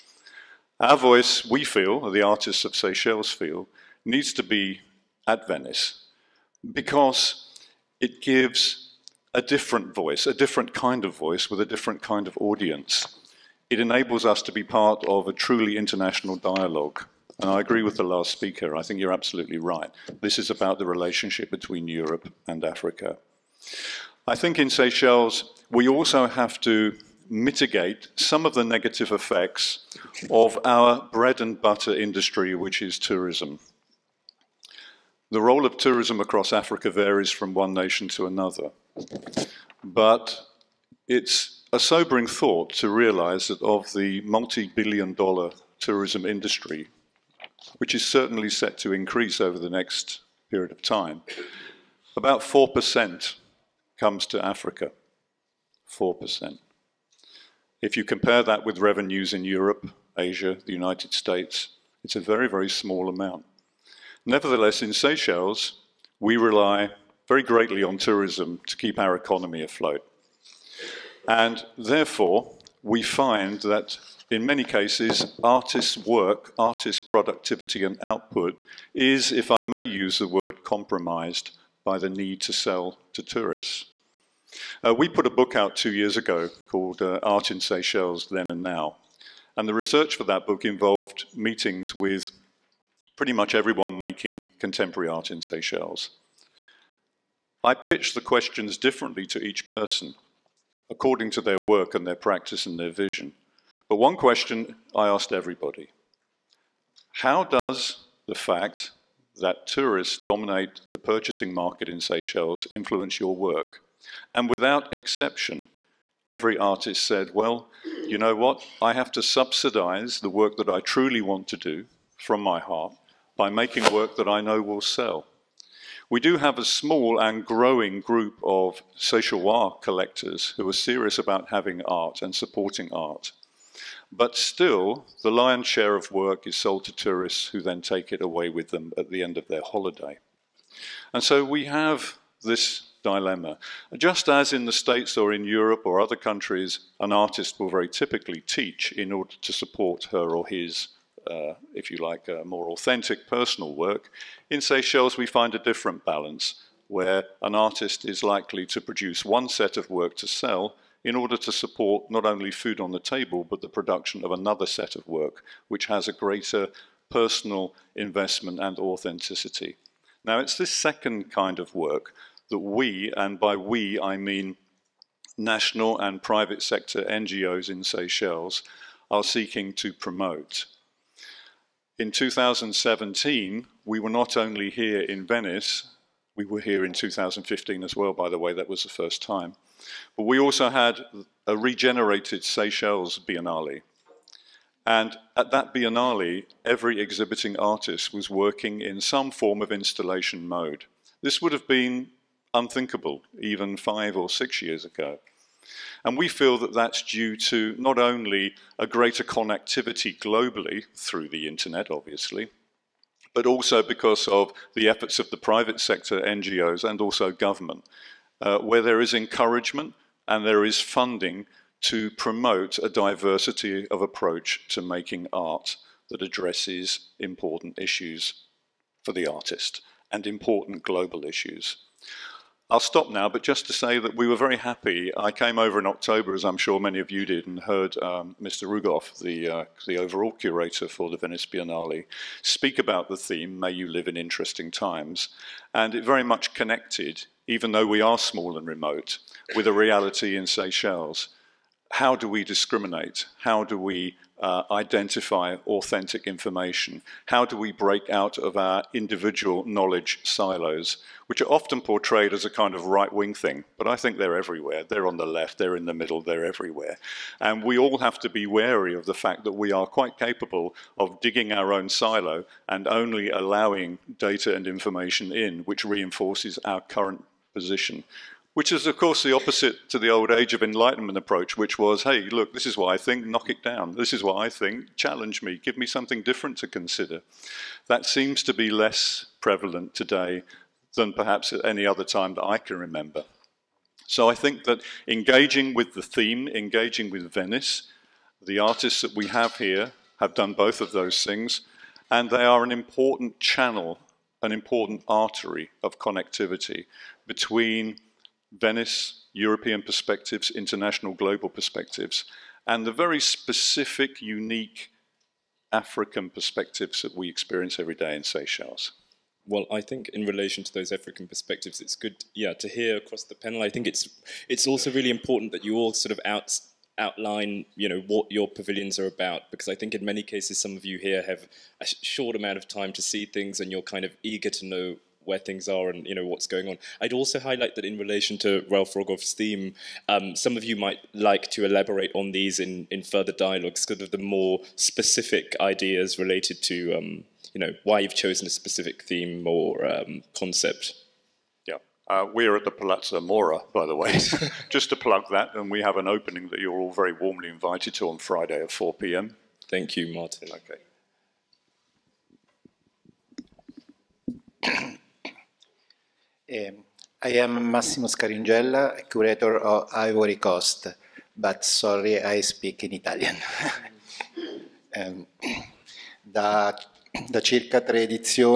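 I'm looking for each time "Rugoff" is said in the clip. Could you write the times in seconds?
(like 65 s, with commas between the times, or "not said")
238 s, 338 s.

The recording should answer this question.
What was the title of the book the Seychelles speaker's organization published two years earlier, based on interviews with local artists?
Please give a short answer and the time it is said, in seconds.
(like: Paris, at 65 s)
Art in Seychelles Then and Now, at 87 s.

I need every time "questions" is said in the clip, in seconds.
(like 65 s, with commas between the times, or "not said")
98 s, 104 s.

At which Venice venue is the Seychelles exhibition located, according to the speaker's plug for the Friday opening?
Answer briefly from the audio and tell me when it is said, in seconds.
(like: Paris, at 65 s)
Palazzo Mora, at 352 s.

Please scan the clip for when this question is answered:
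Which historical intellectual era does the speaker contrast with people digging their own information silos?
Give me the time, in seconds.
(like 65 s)
280 s.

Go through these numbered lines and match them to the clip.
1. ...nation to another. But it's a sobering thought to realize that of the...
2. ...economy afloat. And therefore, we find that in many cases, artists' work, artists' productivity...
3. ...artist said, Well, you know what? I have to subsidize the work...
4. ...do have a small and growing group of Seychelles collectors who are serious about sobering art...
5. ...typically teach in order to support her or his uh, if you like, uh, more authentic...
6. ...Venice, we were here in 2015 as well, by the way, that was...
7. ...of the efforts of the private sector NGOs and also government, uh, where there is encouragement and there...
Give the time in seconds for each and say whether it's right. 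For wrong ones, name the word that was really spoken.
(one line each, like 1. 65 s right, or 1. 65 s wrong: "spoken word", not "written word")
1. 37 s right
2. 69 s right
3. 116 s right
4. 126 s wrong: "having", not "sobering"
5. 147 s right
6. 185 s right
7. 214 s right.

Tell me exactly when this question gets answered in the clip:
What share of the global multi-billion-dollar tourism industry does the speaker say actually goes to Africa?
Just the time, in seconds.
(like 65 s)
52 s.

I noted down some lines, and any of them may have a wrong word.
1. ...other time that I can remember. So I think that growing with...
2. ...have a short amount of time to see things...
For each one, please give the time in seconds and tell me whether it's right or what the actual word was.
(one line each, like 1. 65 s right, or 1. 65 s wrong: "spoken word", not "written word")
1. 291 s wrong: "engaging", not "growing"
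2. 331 s right.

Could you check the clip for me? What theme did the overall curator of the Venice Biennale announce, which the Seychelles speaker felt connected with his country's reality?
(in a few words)
May You Live in Interesting Times.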